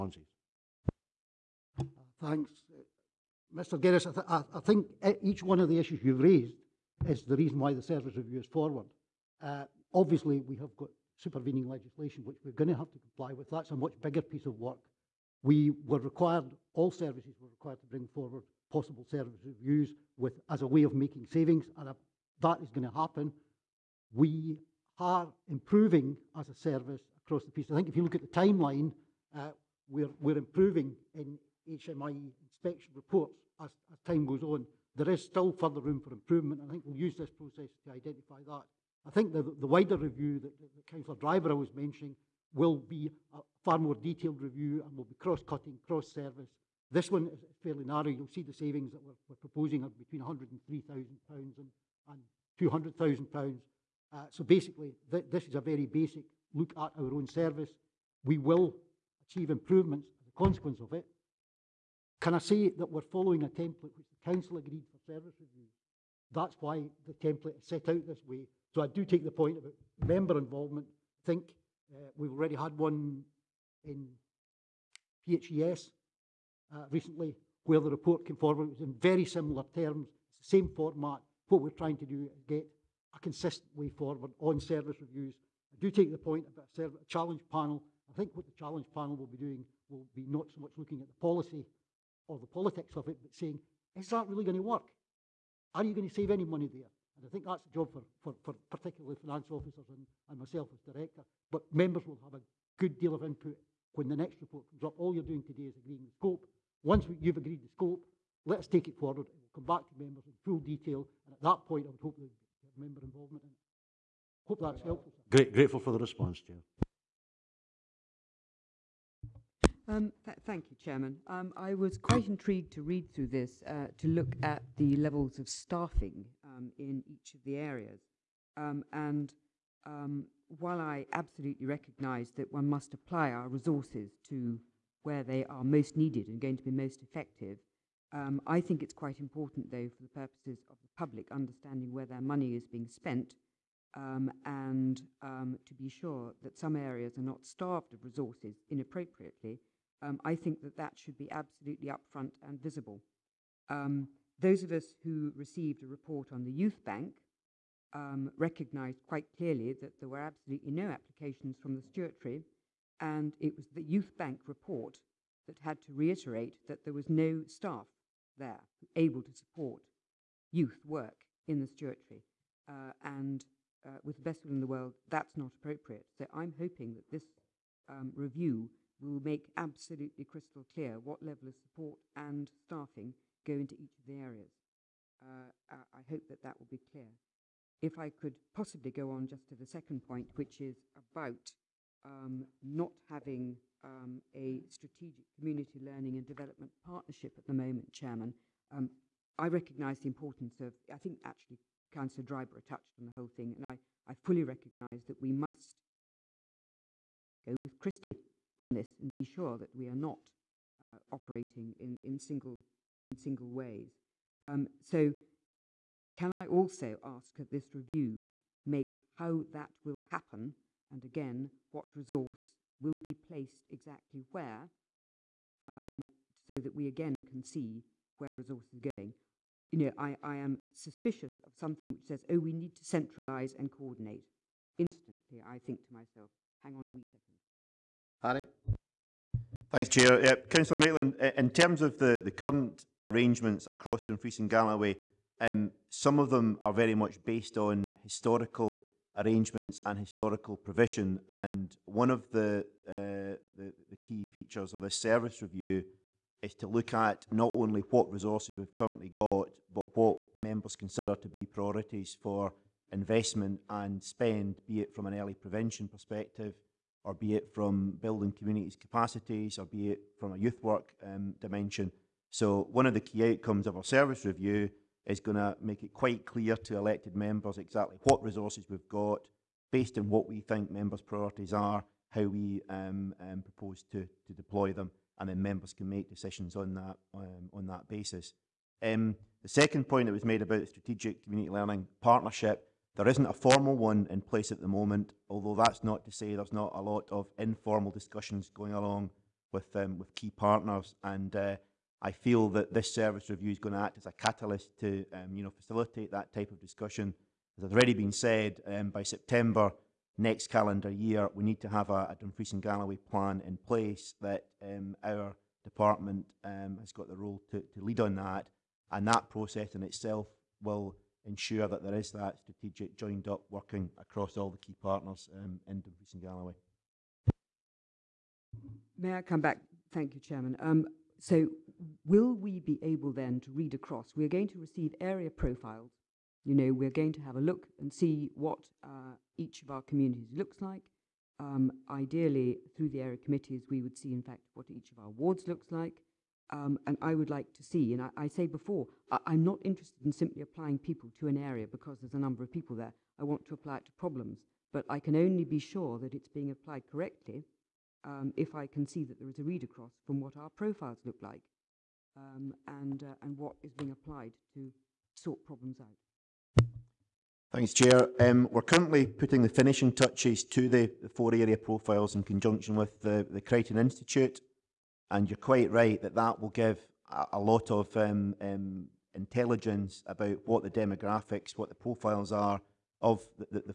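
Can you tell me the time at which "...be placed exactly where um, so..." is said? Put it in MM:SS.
03:42.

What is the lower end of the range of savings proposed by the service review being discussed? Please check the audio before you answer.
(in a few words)
£103,000.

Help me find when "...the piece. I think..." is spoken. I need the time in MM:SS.
00:27.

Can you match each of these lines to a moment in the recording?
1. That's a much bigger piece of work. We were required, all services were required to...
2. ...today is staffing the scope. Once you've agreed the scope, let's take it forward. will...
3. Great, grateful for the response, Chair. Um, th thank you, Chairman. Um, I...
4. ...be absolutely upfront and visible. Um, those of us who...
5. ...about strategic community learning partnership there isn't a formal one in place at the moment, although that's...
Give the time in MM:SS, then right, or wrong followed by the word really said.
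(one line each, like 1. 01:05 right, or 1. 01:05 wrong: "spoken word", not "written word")
1. 00:13 right
2. 01:45 wrong: "agreeing", not "staffing"
3. 01:55 right
4. 02:31 right
5. 04:50 right.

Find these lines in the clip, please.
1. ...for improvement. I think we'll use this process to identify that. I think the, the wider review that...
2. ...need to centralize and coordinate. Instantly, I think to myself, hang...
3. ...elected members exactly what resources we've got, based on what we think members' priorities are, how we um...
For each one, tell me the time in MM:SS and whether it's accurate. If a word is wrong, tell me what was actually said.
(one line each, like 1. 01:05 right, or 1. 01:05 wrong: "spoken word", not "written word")
1. 00:36 right
2. 03:52 right
3. 04:36 right.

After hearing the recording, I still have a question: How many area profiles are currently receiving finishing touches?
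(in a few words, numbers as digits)
4.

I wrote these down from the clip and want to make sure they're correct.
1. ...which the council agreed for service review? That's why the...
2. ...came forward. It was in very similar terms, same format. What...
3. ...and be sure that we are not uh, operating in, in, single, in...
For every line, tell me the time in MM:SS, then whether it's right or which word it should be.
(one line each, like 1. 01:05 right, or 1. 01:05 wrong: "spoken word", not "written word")
1. 01:03 right
2. 01:18 right
3. 03:29 right.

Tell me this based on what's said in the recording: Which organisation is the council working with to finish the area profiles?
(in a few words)
the Crichton Institute.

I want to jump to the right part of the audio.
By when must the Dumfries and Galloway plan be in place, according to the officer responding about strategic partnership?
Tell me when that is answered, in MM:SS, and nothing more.
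05:09.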